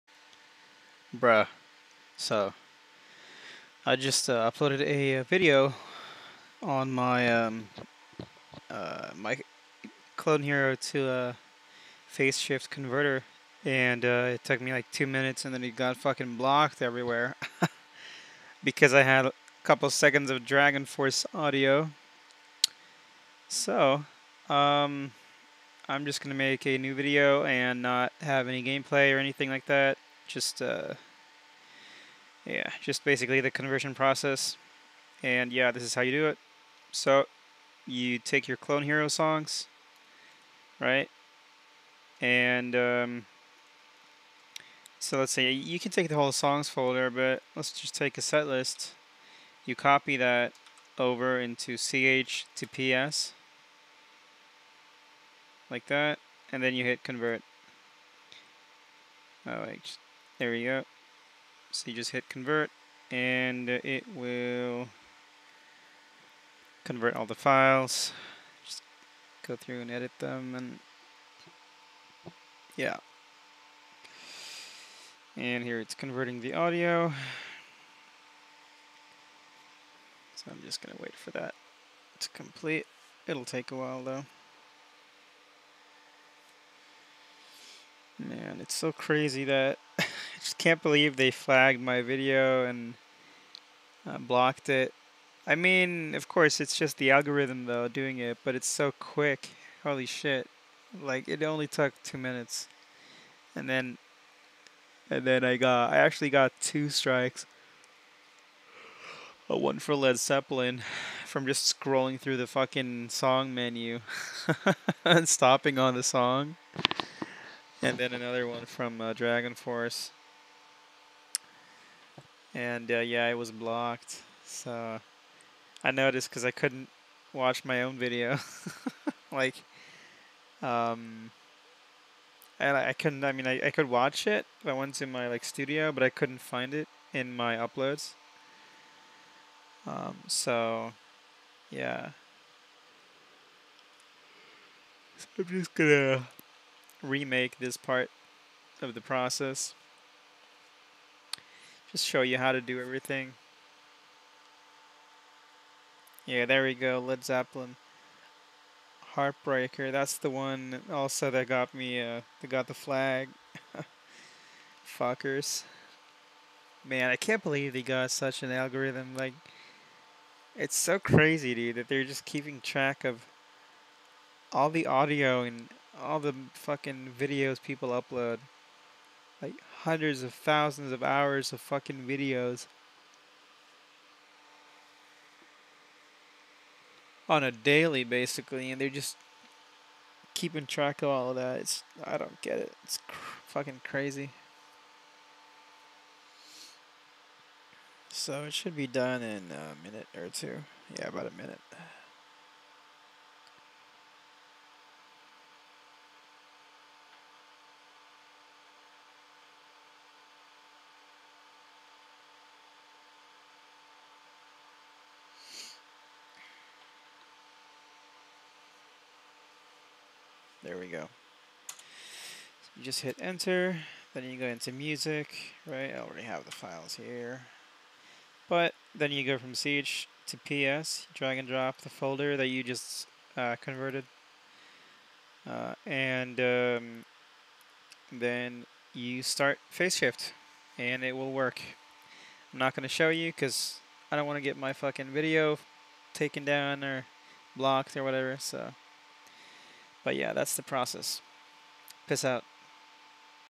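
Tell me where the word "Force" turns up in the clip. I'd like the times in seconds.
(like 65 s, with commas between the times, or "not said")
20 s, 119 s.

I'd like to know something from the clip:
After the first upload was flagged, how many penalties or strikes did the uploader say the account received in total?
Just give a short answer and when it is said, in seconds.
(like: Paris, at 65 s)
2, at 106 s.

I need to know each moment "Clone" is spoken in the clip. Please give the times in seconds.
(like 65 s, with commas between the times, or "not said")
10 s, 38 s.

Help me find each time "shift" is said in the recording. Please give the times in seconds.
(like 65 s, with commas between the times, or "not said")
12 s, 239 s.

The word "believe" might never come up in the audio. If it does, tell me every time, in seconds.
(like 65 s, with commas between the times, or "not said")
90 s, 167 s.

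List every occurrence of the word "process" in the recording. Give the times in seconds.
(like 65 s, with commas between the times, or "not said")
33 s, 149 s, 250 s.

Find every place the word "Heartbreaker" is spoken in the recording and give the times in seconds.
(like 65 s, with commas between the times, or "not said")
159 s.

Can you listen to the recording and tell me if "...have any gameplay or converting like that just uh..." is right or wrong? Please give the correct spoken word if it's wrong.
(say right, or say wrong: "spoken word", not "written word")
wrong: "anything", not "converting".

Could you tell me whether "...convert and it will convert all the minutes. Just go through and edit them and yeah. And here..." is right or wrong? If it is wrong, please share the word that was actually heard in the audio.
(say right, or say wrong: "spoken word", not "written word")
wrong: "files", not "minutes".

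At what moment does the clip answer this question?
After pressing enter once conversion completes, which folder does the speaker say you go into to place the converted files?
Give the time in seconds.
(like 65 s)
224 s.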